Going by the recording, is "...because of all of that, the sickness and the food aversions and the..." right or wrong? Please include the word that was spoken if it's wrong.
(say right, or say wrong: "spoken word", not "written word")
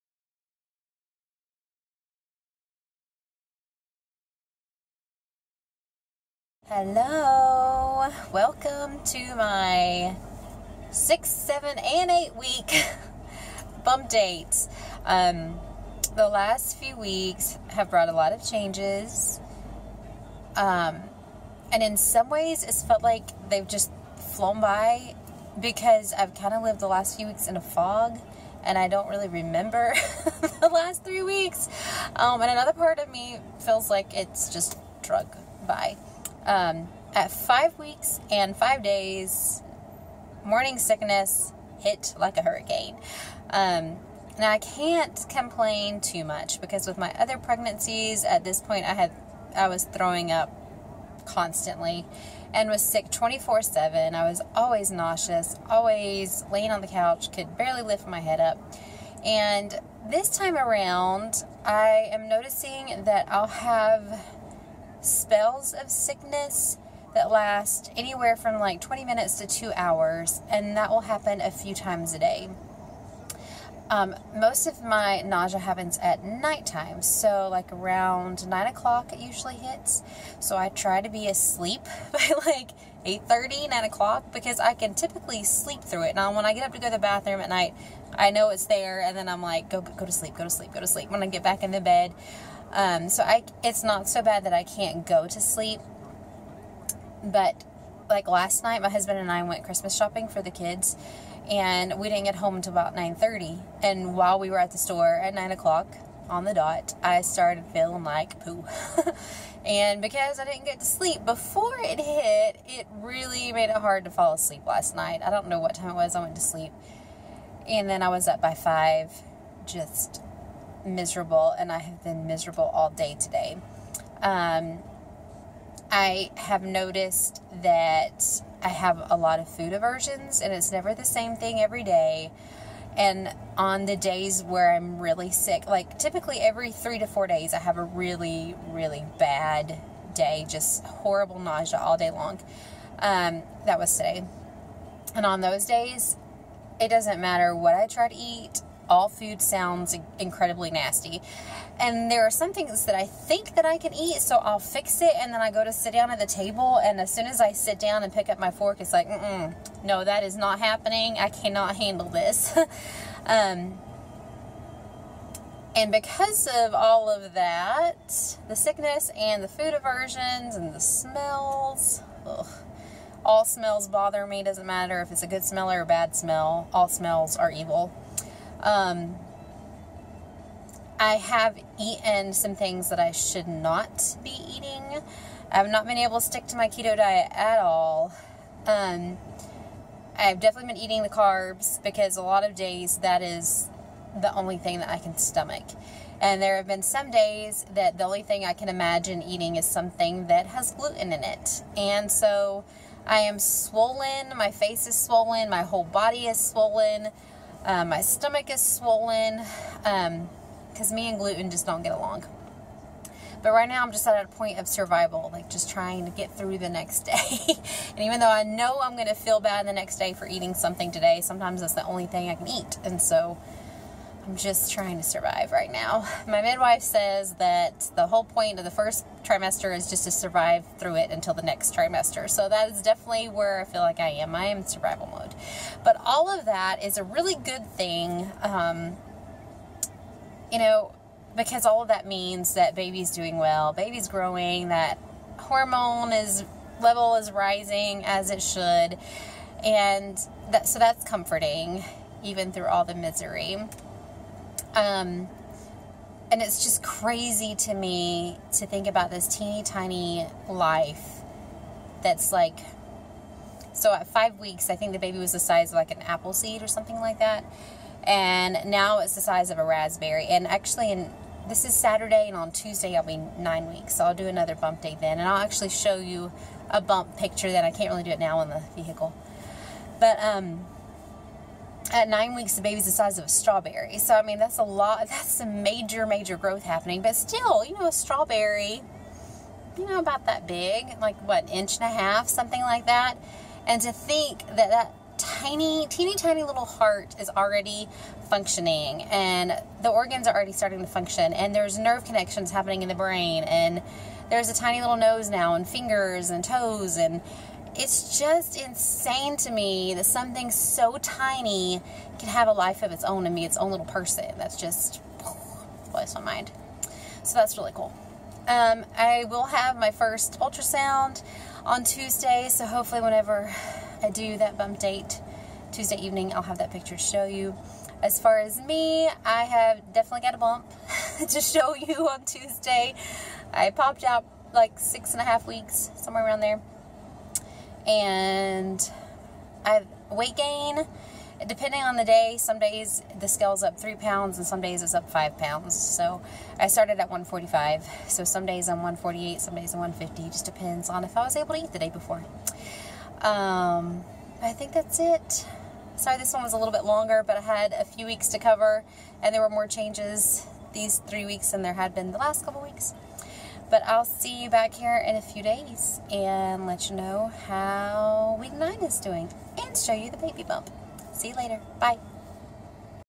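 right.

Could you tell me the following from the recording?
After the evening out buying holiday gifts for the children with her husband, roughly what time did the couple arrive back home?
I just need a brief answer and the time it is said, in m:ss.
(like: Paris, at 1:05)
9:30, at 1:42.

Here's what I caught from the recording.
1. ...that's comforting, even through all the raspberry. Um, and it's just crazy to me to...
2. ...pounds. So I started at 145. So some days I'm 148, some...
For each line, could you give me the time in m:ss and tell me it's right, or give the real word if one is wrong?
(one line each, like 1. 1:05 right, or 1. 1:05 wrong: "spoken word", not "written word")
1. 4:10 wrong: "misery", not "raspberry"
2. 5:45 right.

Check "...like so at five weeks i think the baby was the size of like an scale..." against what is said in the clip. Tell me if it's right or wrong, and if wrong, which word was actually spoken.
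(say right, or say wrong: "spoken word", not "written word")
wrong: "apple", not "scale".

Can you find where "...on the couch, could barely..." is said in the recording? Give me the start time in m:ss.
0:56.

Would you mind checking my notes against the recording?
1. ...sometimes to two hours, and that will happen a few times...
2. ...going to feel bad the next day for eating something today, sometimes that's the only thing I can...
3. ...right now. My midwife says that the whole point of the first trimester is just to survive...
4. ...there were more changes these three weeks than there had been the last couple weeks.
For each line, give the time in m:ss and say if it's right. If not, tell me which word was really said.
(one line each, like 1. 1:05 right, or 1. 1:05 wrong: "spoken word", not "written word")
1. 1:09 wrong: "minutes", not "sometimes"
2. 3:38 right
3. 3:45 right
4. 5:59 right.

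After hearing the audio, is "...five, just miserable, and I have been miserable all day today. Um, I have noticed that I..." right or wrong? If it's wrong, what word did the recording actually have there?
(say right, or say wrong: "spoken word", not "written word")
right.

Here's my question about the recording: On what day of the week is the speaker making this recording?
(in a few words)
Saturday.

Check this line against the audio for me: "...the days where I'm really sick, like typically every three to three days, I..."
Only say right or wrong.
wrong.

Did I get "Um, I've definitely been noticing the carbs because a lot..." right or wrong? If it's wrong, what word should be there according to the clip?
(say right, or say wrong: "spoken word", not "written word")
wrong: "eating", not "noticing".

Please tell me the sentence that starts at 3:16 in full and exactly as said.
And there have been some days that the only thing I can imagine eating is something that has gluten in it.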